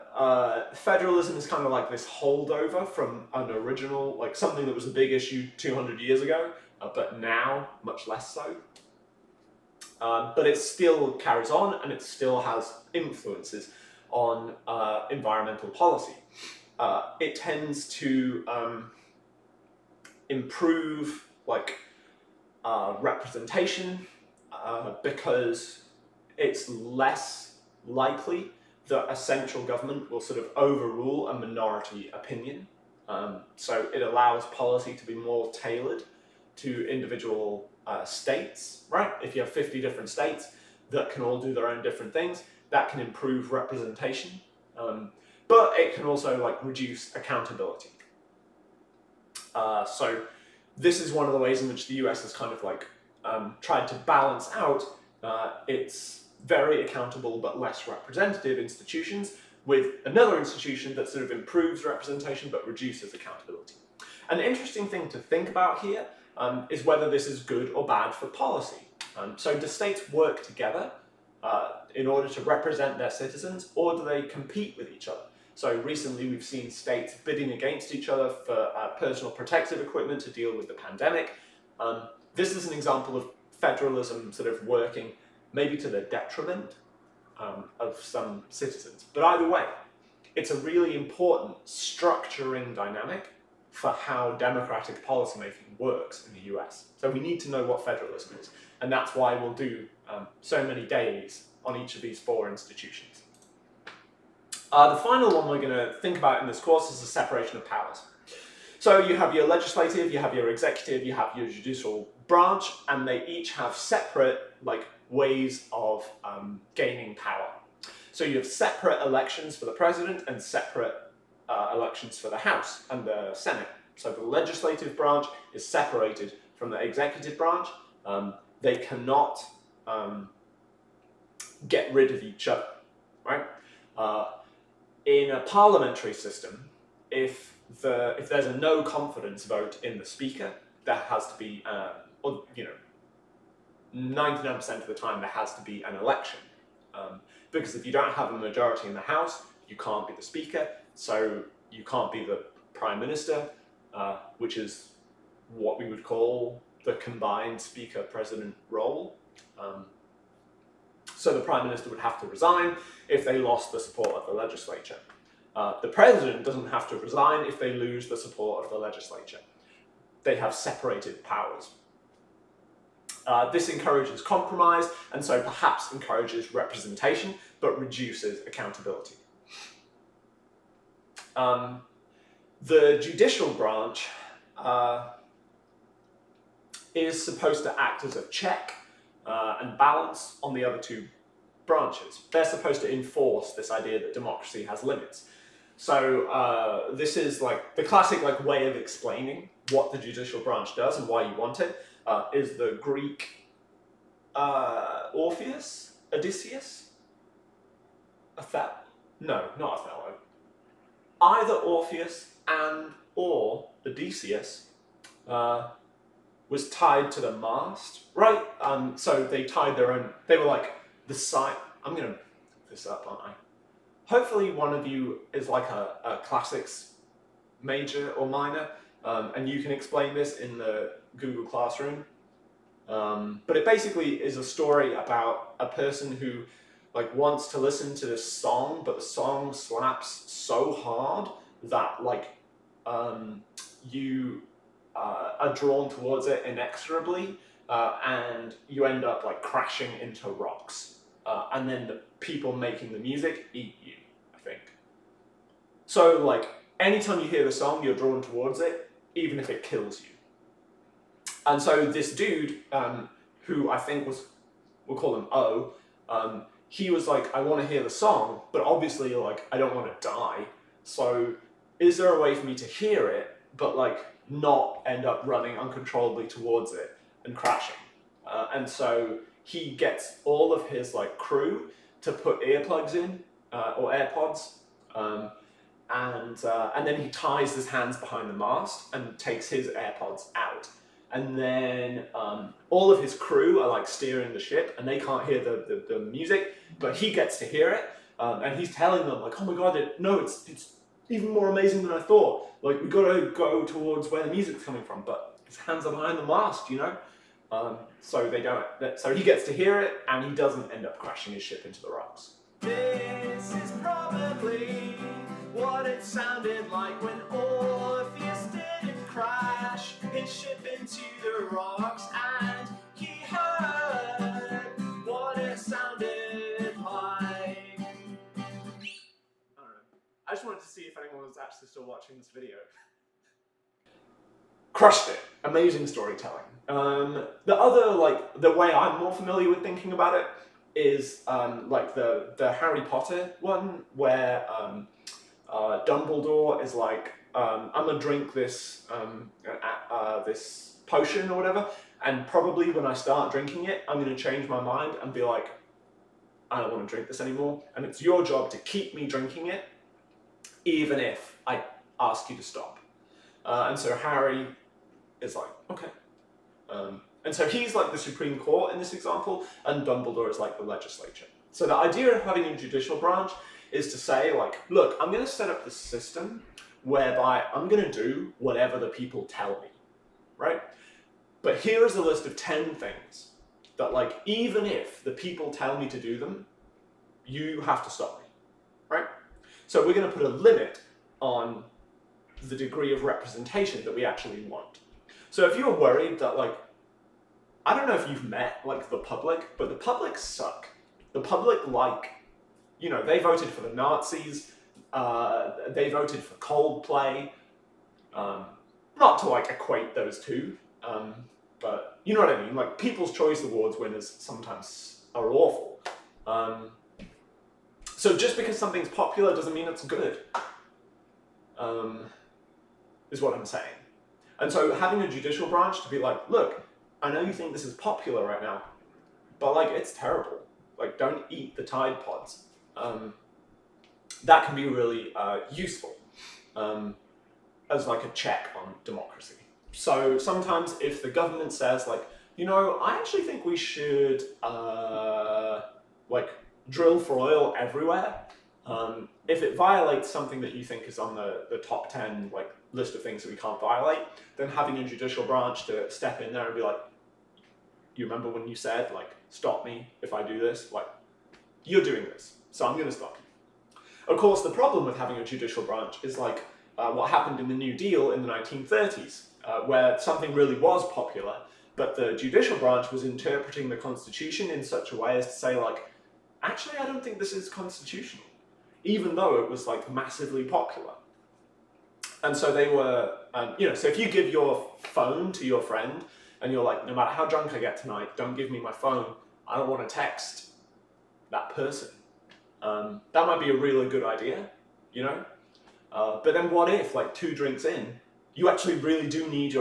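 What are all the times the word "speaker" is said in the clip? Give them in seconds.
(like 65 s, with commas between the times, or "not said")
140 s, 150 s, 157 s.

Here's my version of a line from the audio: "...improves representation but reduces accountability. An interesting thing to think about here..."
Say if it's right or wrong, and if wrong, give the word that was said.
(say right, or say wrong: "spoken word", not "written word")
right.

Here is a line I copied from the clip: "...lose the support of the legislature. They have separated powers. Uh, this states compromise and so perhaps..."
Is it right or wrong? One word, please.
wrong.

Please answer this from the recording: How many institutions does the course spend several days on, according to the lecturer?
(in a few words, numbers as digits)
4.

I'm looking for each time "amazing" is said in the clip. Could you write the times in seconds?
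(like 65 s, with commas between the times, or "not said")
301 s, 335 s.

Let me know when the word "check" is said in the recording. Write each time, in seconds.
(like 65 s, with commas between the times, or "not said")
188 s, 438 s.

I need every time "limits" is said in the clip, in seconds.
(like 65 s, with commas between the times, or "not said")
194 s, 390 s.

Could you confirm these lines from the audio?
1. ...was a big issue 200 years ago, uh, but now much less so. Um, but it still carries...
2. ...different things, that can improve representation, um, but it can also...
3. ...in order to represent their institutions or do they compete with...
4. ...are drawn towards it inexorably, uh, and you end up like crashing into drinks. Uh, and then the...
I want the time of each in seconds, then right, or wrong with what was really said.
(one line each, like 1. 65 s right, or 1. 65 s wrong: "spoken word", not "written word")
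1. 4 s right
2. 41 s right
3. 71 s wrong: "citizens", not "institutions"
4. 245 s wrong: "rocks", not "drinks".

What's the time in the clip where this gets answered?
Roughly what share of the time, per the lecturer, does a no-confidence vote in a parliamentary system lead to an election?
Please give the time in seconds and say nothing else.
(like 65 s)
143 s.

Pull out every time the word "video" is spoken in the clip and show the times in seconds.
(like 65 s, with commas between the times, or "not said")
332 s.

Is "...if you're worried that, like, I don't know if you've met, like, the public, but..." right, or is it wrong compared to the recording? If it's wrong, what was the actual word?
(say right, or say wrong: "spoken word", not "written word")
right.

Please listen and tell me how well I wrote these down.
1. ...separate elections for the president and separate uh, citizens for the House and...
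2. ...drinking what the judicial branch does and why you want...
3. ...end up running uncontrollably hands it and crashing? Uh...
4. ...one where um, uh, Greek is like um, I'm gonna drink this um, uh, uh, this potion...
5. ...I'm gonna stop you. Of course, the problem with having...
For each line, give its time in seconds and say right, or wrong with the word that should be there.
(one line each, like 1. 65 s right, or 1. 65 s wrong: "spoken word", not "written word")
1. 118 s wrong: "elections", not "citizens"
2. 198 s wrong: "explaining", not "drinking"
3. 274 s wrong: "towards", not "hands"
4. 343 s wrong: "Dumbledore", not "Greek"
5. 462 s right.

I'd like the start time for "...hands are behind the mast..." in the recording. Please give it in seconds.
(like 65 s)
305 s.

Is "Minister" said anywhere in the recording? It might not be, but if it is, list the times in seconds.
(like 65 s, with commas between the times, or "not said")
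152 s, 161 s.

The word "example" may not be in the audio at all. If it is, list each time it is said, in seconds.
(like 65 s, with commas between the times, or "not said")
82 s, 368 s.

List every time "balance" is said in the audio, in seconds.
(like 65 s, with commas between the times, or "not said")
54 s, 189 s.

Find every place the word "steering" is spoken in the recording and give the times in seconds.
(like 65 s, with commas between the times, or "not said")
293 s.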